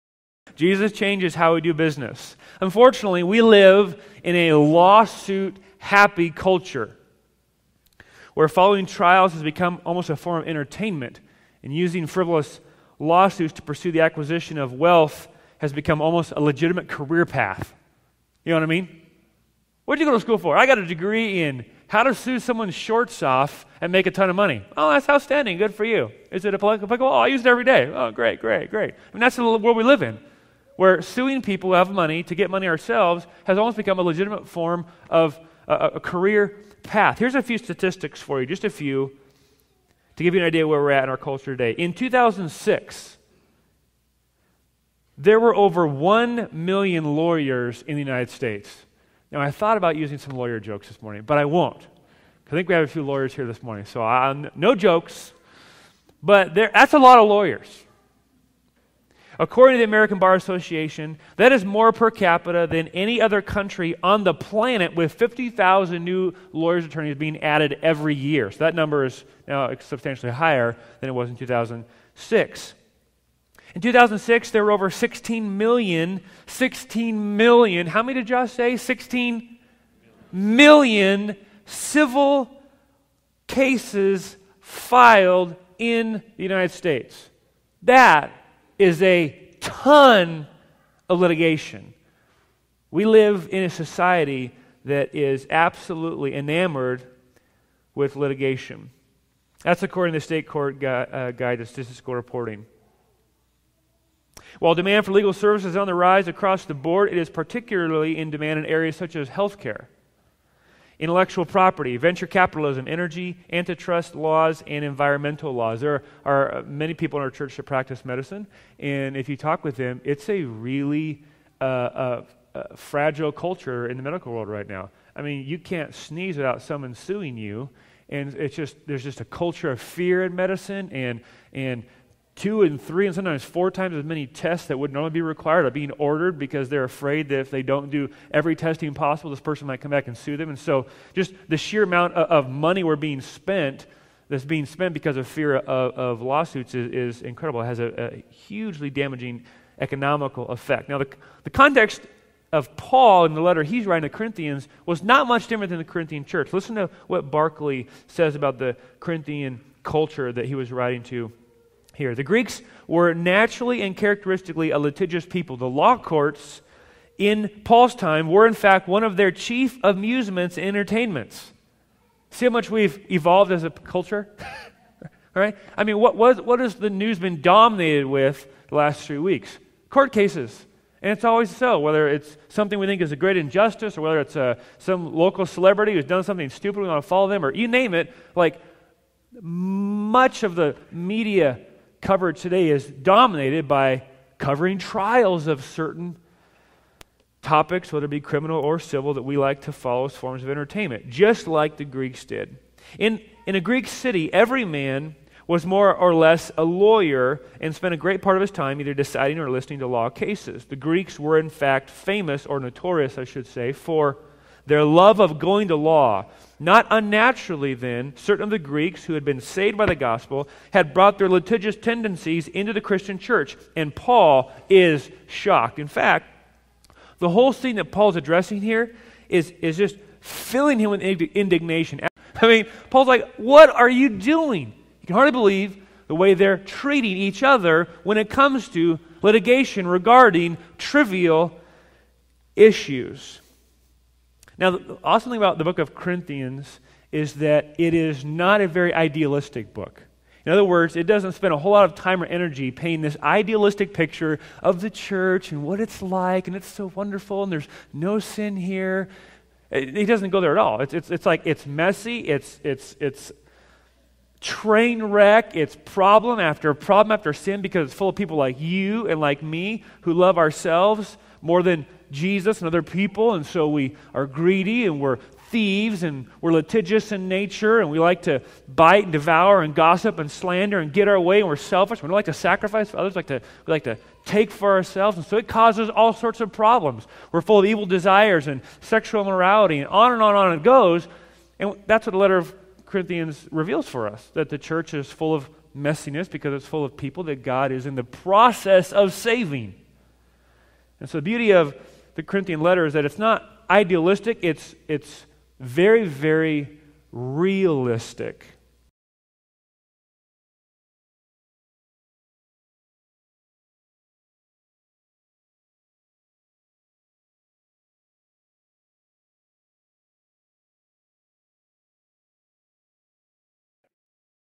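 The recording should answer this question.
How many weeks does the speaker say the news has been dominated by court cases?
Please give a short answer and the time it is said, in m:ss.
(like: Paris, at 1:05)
three weeks, at 2:59.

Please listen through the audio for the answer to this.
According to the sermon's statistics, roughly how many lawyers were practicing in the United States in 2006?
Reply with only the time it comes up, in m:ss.
0:45.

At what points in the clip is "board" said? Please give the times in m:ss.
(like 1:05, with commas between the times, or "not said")
1:46.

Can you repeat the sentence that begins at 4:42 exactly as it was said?
We don't like to sacrifice for others, we like to, we like to take for ourselves.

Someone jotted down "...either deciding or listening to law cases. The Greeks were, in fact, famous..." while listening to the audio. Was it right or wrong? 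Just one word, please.
right.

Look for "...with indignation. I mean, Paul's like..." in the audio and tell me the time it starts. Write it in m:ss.
3:50.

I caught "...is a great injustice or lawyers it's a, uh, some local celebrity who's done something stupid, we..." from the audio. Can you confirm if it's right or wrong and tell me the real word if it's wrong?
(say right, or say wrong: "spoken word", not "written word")
wrong: "whether", not "lawyers".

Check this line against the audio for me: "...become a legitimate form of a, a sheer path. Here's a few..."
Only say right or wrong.
wrong.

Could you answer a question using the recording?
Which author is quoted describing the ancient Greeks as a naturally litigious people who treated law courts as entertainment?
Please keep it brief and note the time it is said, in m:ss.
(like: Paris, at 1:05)
Barclay, at 2:37.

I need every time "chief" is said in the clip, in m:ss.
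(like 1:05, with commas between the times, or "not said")
2:49.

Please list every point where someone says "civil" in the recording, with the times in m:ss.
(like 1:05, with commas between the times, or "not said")
1:21, 3:18.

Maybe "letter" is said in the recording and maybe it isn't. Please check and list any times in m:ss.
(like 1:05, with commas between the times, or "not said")
2:33, 4:52, 5:02.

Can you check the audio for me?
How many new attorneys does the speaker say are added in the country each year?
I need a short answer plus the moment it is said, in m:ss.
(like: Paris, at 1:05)
50,000, at 1:05.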